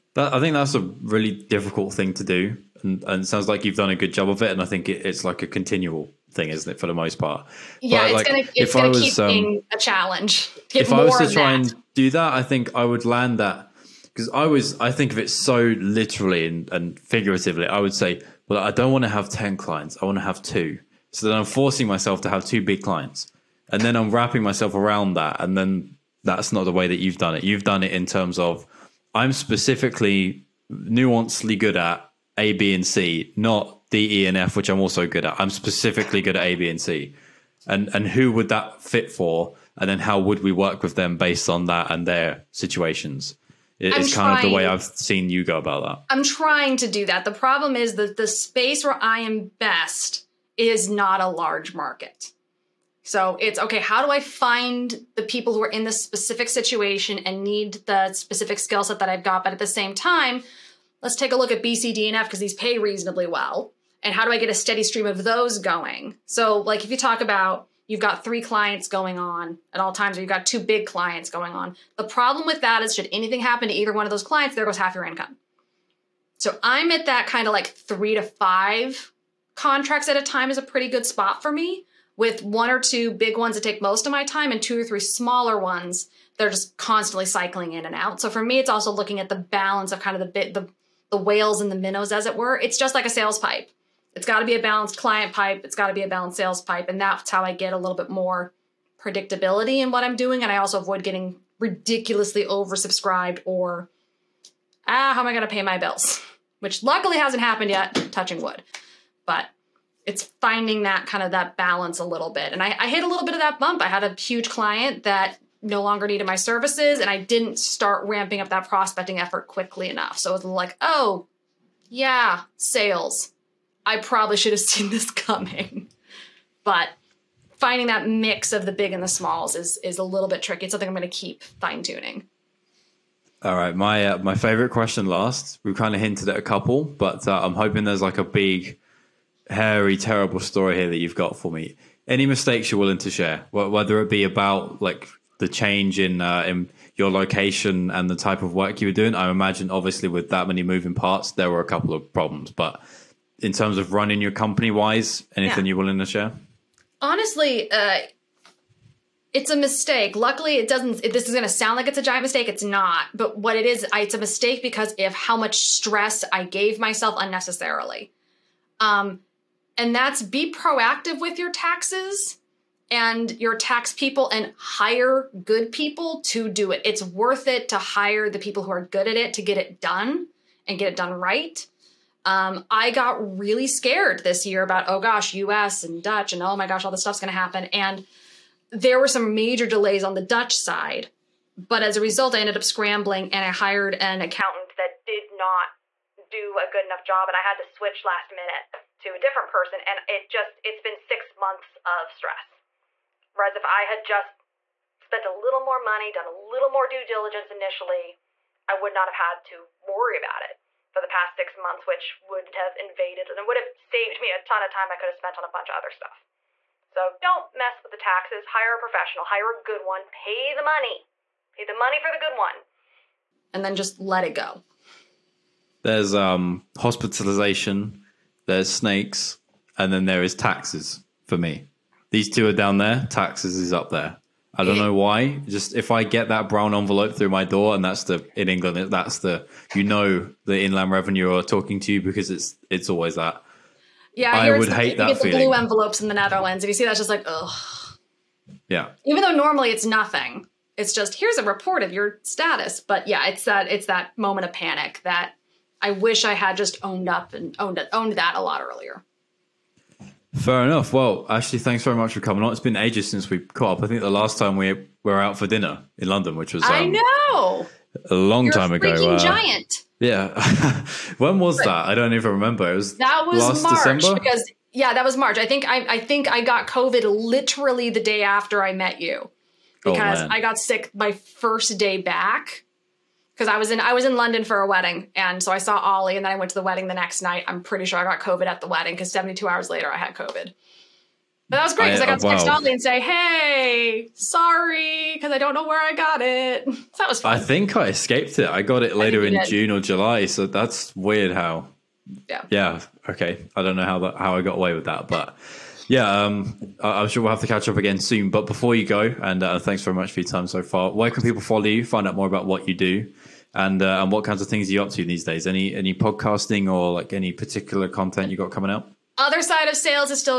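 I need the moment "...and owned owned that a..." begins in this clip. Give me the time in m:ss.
4:17.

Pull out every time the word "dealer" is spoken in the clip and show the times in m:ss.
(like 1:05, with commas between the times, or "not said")
not said.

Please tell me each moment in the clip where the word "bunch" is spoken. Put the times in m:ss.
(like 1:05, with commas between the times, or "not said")
3:35.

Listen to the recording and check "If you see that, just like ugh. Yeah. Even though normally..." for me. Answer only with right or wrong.
right.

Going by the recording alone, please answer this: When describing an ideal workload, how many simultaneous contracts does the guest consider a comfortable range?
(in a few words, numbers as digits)
3 to 5.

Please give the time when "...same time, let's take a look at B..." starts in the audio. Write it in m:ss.
0:59.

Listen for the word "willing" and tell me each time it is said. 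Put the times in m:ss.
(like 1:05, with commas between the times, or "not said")
2:22, 2:35.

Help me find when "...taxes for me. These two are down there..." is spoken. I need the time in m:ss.
3:50.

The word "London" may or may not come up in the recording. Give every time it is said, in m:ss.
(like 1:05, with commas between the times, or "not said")
4:26, 4:44.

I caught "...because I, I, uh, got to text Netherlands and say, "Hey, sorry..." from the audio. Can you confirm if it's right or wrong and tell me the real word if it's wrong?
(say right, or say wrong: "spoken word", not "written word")
wrong: "Ollie", not "Netherlands".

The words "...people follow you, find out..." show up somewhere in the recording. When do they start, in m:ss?
5:11.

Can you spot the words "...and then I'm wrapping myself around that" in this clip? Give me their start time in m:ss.
0:23.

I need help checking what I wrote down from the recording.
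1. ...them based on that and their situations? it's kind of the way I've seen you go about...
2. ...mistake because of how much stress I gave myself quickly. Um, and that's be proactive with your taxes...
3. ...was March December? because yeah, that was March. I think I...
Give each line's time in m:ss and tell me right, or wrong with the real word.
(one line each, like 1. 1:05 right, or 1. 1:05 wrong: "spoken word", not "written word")
1. 0:40 right
2. 2:44 wrong: "unnecessarily", not "quickly"
3. 4:33 right.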